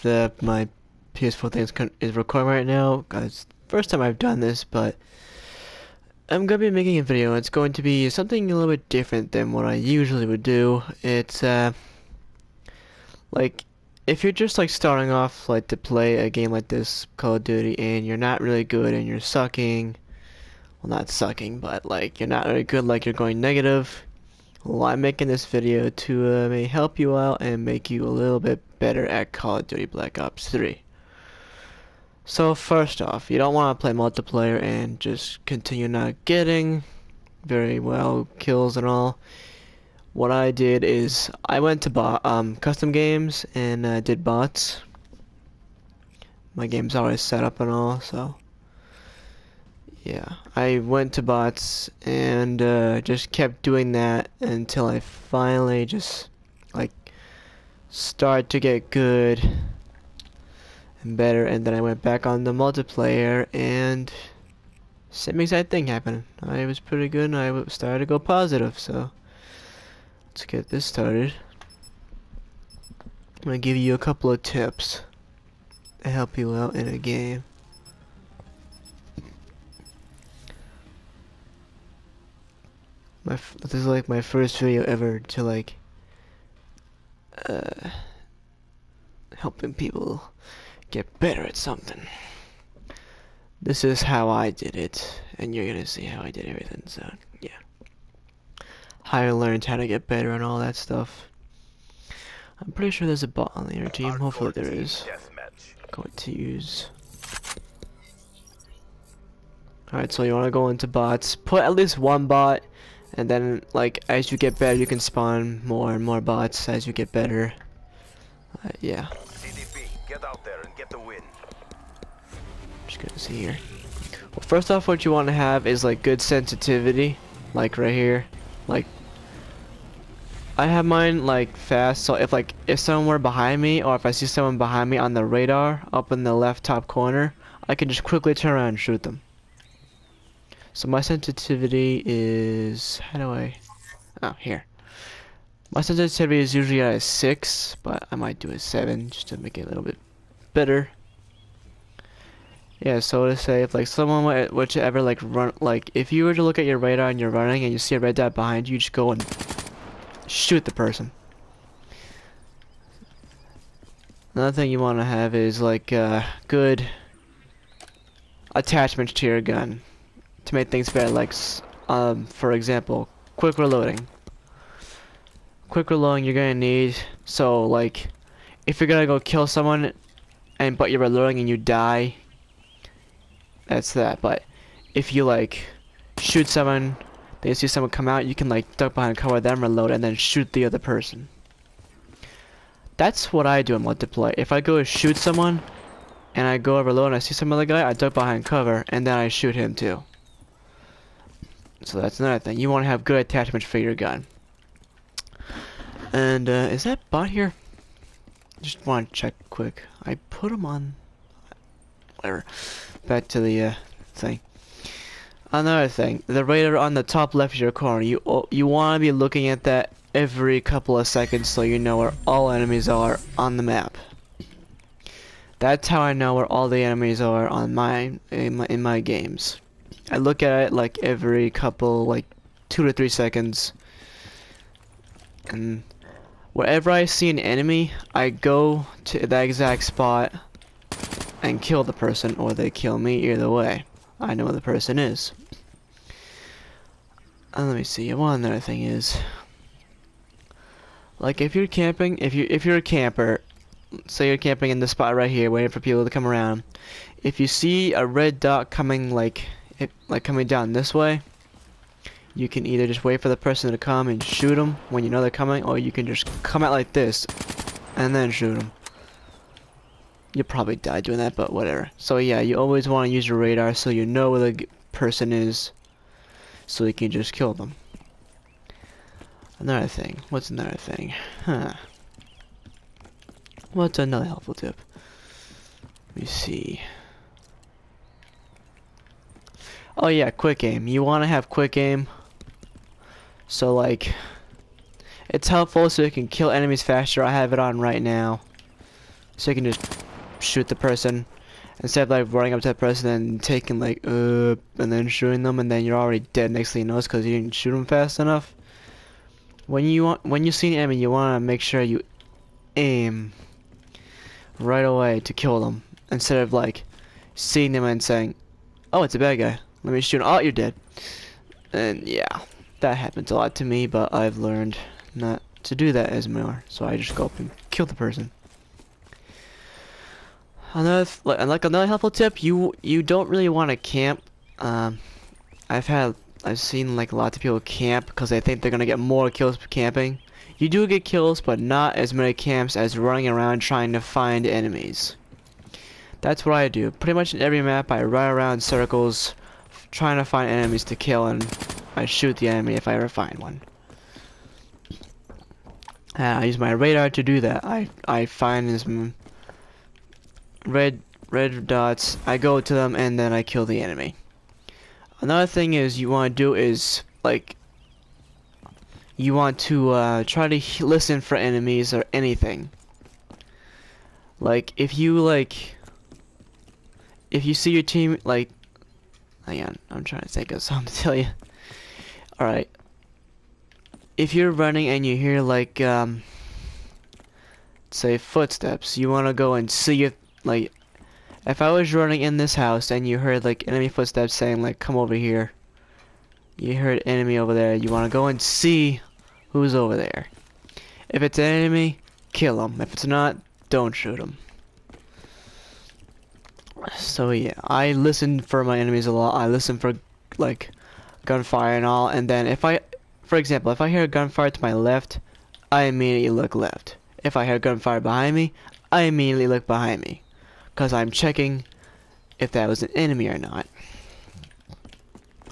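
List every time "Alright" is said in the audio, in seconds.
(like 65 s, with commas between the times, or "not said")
109 s, 382 s.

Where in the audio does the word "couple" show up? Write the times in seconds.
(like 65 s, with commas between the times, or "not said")
73 s, 220 s, 231 s.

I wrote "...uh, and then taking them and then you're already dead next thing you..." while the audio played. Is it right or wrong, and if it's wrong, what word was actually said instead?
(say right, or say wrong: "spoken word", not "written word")
wrong: "shooting", not "taking".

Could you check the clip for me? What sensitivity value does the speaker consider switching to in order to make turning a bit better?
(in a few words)
7.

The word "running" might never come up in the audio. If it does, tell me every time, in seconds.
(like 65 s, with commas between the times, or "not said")
157 s, 302 s, 342 s, 384 s, 391 s.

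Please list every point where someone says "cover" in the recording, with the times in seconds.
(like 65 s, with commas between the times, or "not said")
189 s, 198 s.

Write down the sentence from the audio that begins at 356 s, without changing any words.
Uh, I use my radar to do that.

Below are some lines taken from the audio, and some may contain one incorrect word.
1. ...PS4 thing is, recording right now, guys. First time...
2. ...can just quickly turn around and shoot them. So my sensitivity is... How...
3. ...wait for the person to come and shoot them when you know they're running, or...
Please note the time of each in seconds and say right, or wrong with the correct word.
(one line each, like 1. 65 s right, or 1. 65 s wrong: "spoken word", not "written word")
1. 1 s right
2. 137 s right
3. 263 s wrong: "coming", not "running".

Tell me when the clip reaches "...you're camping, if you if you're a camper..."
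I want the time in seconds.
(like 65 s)
251 s.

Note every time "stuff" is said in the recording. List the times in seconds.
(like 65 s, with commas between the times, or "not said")
100 s.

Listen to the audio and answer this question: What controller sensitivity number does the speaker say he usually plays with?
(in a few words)
6.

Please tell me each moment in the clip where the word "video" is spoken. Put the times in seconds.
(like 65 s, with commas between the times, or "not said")
7 s, 25 s, 84 s.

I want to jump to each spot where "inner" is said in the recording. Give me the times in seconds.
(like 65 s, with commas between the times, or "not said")
103 s.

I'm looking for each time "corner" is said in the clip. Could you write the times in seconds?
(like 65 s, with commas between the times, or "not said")
136 s, 217 s.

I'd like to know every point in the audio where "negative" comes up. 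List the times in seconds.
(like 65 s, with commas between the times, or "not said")
23 s.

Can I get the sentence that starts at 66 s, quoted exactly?
I was pretty good and I started to go positive so let's get this started.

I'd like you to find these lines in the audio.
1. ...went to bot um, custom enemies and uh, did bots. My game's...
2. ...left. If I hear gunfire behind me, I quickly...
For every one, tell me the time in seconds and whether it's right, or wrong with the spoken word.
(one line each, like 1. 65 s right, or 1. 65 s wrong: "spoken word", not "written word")
1. 41 s wrong: "games", not "enemies"
2. 416 s wrong: "immediately", not "quickly".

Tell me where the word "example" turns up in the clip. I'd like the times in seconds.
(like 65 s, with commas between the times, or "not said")
172 s, 413 s.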